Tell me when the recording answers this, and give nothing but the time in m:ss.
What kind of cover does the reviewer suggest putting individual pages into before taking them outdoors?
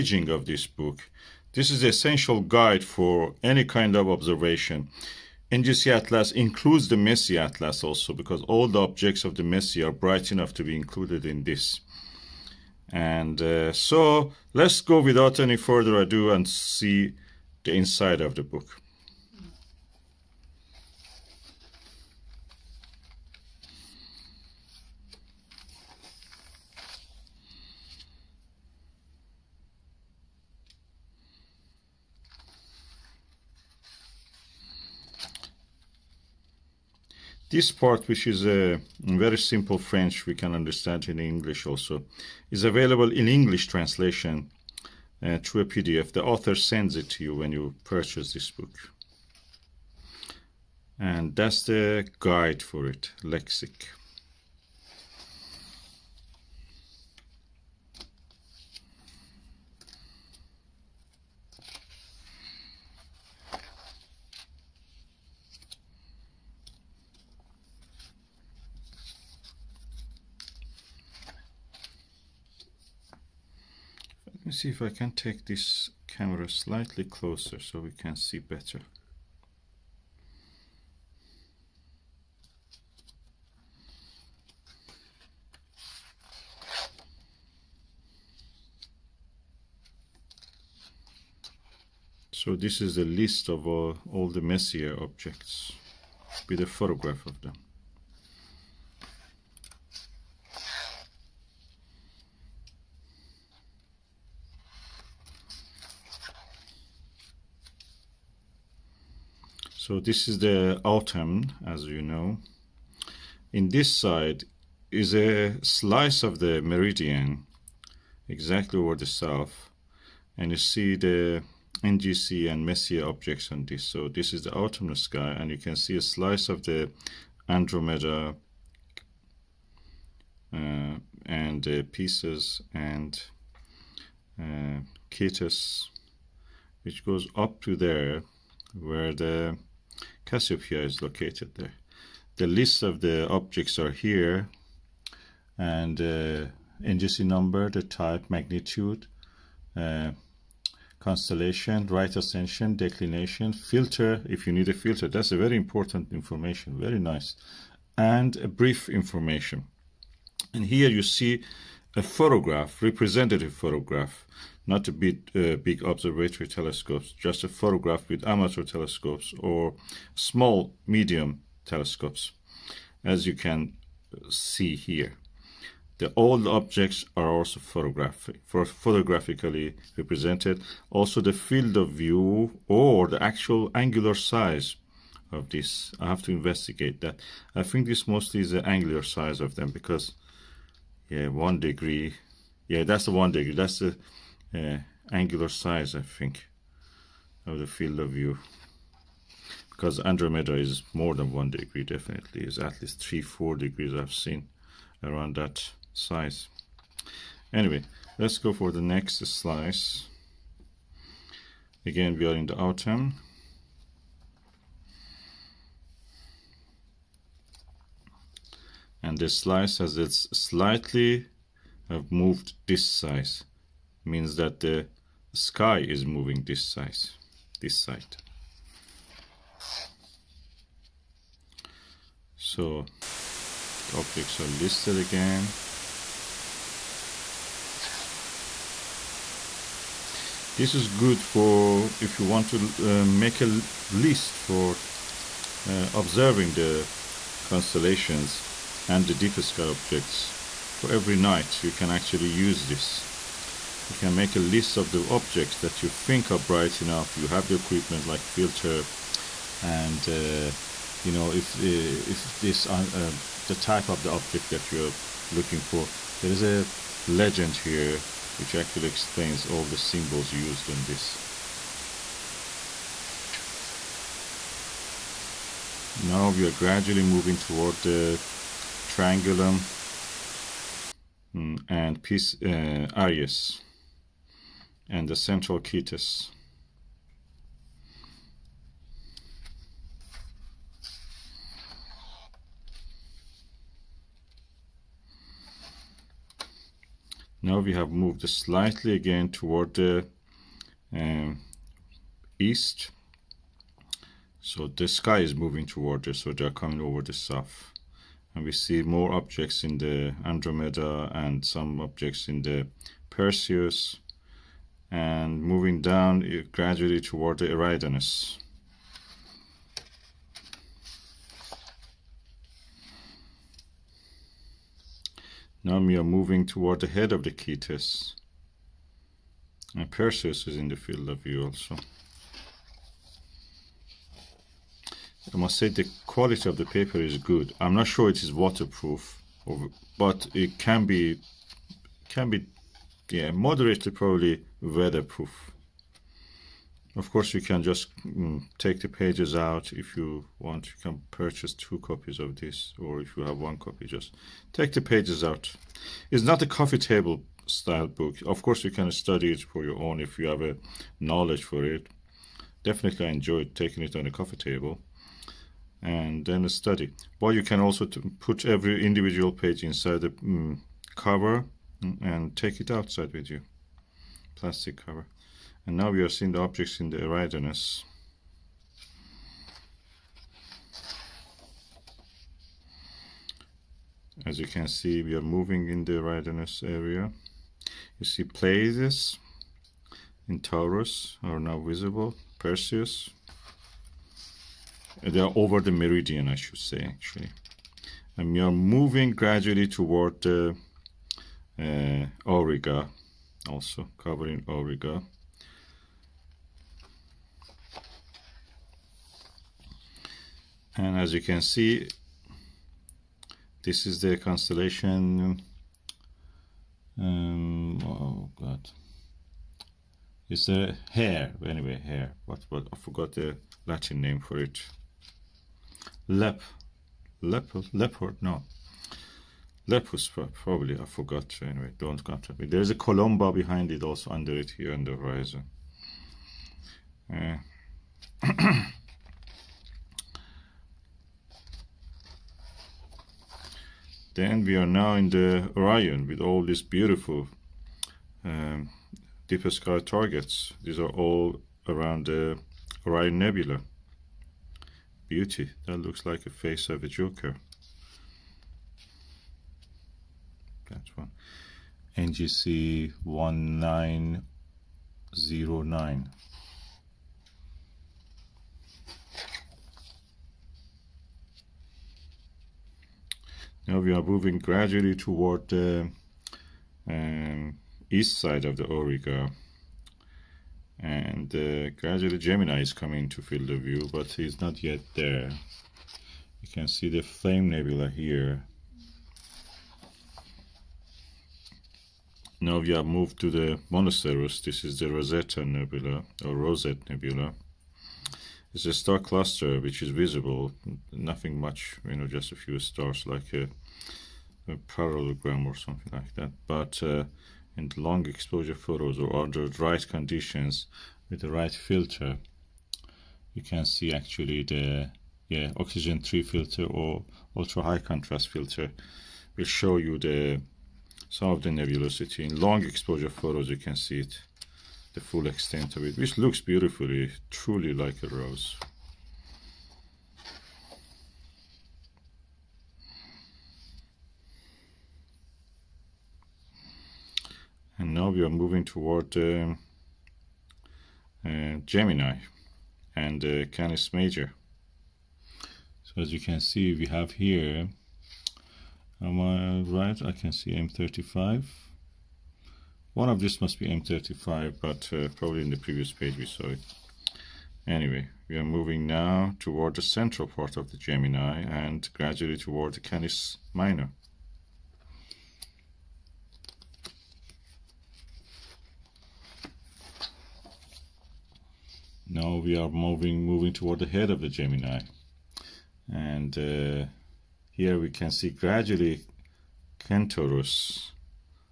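6:14.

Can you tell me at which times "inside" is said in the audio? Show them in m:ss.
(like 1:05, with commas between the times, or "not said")
0:17, 6:09.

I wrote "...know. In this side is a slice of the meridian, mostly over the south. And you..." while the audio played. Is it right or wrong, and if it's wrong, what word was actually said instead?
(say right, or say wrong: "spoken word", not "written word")
wrong: "exactly", not "mostly".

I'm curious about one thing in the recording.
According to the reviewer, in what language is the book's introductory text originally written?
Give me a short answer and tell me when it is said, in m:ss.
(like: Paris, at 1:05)
French, at 0:39.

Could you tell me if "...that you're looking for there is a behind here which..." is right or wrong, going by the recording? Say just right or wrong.
wrong.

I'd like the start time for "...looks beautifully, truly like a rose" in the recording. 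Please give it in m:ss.
8:46.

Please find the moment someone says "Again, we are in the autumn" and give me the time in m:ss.
3:31.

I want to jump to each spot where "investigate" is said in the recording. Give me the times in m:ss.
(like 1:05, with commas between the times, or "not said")
3:06.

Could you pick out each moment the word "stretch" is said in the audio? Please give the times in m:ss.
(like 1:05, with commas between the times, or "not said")
not said.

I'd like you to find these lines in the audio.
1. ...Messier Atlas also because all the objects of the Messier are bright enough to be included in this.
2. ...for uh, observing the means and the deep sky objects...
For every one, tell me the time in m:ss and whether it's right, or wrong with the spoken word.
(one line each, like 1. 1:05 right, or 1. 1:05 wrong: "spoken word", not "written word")
1. 0:06 right
2. 4:04 wrong: "constellations", not "means".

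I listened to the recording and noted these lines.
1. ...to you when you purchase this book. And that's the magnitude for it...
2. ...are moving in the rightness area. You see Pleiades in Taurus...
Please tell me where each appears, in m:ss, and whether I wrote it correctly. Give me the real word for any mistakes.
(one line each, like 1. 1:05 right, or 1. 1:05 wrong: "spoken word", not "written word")
1. 0:47 wrong: "guide", not "magnitude"
2. 6:25 right.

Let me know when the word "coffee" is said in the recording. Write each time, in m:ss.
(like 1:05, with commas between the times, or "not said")
5:56, 6:04.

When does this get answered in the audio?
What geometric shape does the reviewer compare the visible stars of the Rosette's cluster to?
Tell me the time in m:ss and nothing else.
8:24.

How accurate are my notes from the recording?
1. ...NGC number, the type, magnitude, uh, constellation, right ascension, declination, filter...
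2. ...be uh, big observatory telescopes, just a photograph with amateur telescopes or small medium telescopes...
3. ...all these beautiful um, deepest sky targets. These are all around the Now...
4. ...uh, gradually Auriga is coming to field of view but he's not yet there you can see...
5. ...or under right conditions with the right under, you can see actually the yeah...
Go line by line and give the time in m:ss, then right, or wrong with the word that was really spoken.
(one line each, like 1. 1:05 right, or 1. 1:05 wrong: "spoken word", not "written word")
1. 2:26 right
2. 2:44 right
3. 7:26 wrong: "Orion", not "Now"
4. 8:01 wrong: "Gemini", not "Auriga"
5. 8:28 wrong: "filter", not "under".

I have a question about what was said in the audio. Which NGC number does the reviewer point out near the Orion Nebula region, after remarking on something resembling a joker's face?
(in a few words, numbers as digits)
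NGC 1909.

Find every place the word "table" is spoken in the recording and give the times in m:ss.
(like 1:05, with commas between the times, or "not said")
5:56, 6:04.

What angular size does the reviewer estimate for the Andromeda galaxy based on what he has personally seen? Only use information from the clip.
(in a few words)
three, four degrees.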